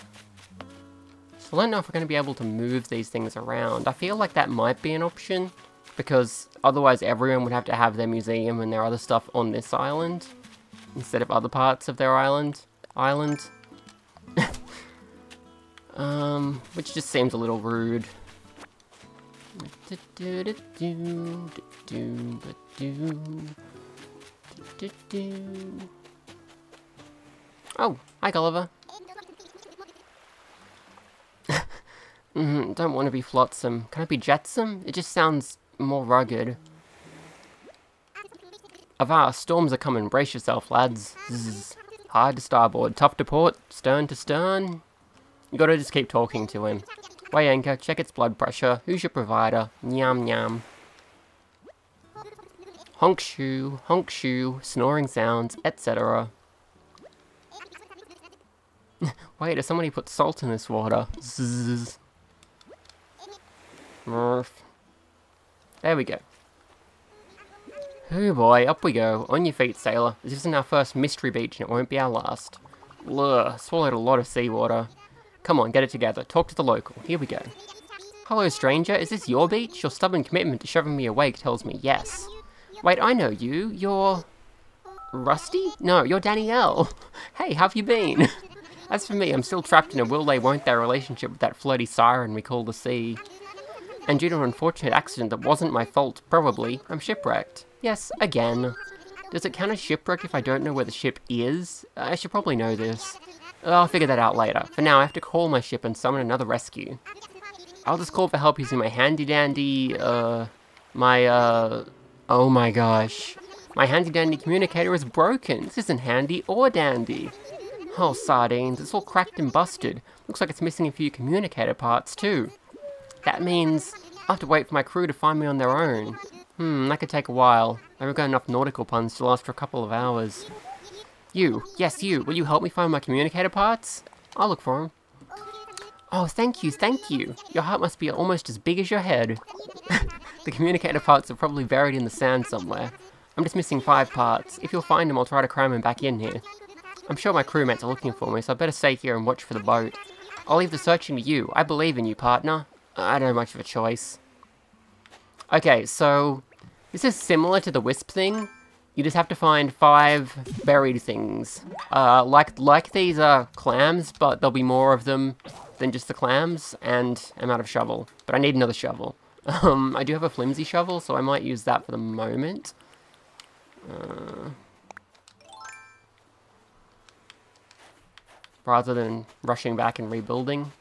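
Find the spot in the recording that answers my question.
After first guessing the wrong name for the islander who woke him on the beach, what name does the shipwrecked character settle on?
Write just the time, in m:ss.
1:26.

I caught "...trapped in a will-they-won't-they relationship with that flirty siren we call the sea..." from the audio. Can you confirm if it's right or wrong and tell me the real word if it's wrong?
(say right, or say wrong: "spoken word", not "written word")
right.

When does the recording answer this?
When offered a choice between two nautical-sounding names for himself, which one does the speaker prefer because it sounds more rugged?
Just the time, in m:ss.
0:34.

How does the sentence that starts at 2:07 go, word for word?
I've got enough nautical puns to last for a couple of hours.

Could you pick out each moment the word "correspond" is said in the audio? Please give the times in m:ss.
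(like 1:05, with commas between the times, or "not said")
not said.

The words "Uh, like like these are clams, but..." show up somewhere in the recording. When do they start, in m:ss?
2:41.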